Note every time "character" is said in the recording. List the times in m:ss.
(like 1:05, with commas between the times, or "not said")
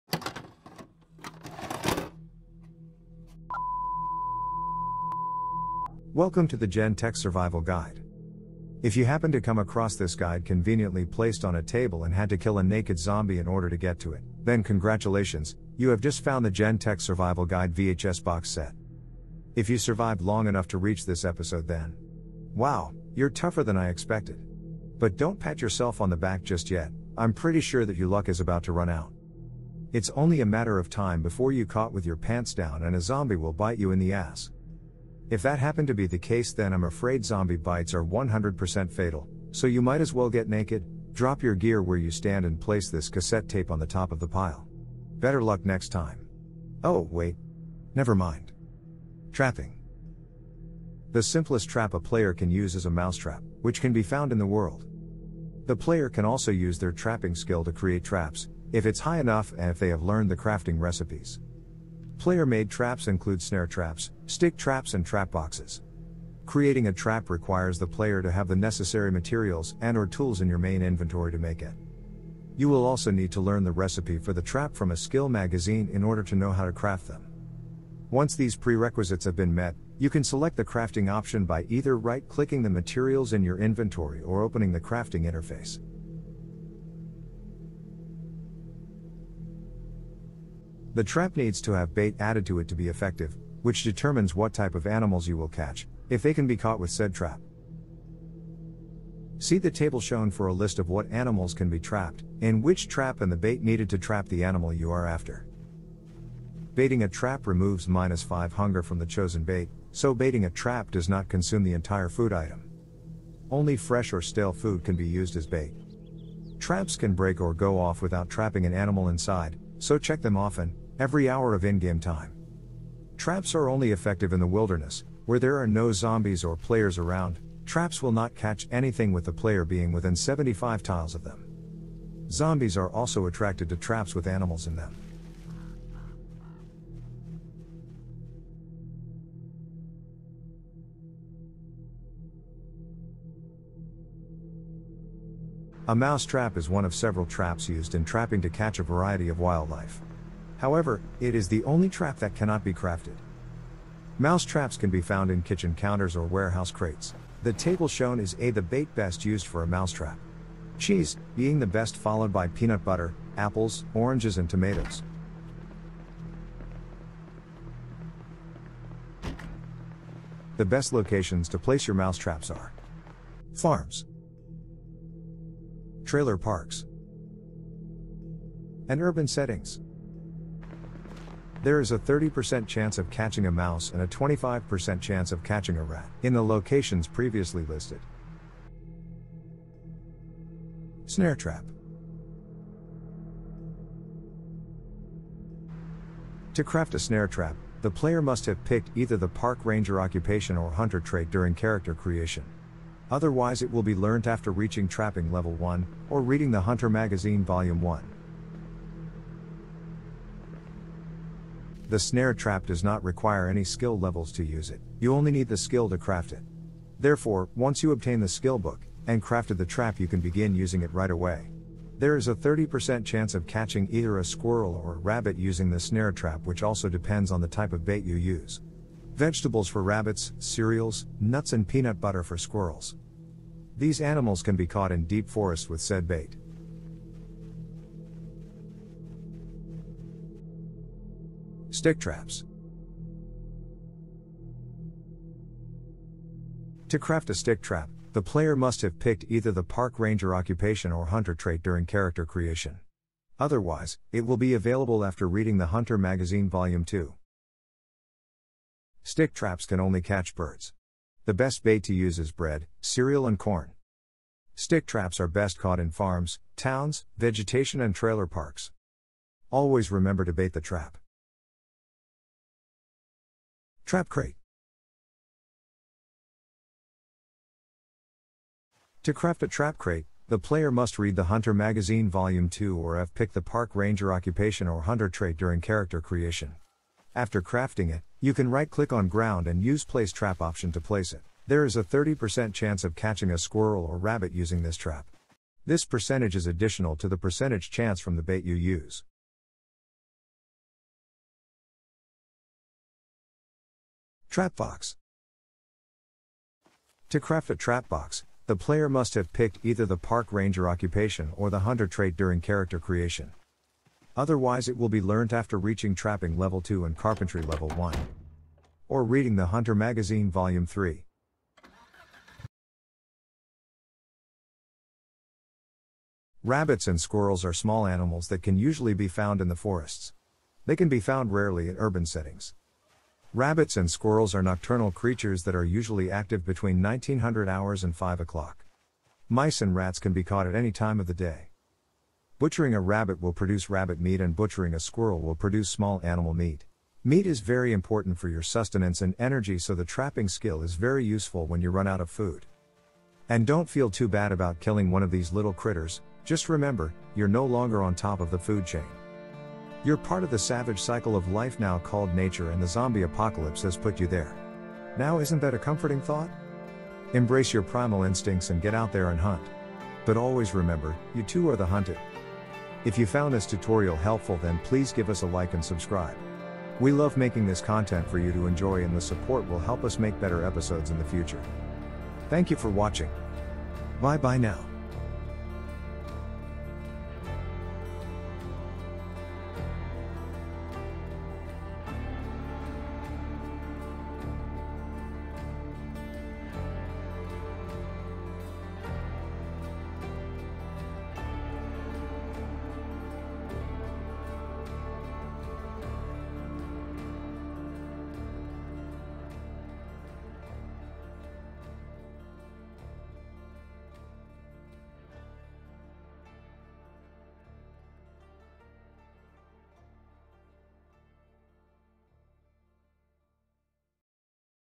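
3:21, 4:11, 4:45, 5:12.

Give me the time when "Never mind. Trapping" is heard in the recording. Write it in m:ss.
0:47.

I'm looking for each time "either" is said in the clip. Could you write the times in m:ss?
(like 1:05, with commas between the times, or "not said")
1:21, 3:18, 3:43, 4:09, 5:09.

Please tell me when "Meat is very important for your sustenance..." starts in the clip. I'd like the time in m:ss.
5:47.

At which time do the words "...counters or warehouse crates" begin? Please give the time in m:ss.
2:35.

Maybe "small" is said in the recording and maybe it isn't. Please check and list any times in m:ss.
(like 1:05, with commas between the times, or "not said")
5:27, 5:45.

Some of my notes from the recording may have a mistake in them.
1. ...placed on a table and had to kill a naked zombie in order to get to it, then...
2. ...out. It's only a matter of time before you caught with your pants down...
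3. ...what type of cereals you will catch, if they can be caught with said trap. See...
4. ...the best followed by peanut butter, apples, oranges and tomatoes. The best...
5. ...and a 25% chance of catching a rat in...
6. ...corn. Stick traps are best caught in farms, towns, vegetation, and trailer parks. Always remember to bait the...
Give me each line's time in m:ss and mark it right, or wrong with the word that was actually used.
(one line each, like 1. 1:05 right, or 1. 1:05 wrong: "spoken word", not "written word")
1. 0:11 right
2. 0:28 right
3. 1:34 wrong: "animals", not "cereals"
4. 2:41 right
5. 3:03 right
6. 4:23 right.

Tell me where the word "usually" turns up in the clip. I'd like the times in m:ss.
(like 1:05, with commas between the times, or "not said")
5:28, 5:35.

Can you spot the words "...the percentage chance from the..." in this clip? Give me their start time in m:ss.
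4:57.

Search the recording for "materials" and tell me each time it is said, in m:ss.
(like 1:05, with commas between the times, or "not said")
1:09, 1:22.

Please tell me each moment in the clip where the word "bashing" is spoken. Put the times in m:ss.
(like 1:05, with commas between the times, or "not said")
not said.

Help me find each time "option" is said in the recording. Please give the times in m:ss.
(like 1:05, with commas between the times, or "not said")
1:21, 4:50.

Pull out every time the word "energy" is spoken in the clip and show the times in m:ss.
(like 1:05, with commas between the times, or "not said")
5:49.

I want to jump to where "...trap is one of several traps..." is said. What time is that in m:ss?
2:26.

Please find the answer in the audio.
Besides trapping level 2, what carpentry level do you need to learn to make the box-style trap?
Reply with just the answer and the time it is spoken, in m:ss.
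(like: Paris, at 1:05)
1, at 5:16.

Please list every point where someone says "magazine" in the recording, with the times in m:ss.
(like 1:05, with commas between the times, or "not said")
1:15, 3:26, 4:15, 4:41, 5:19.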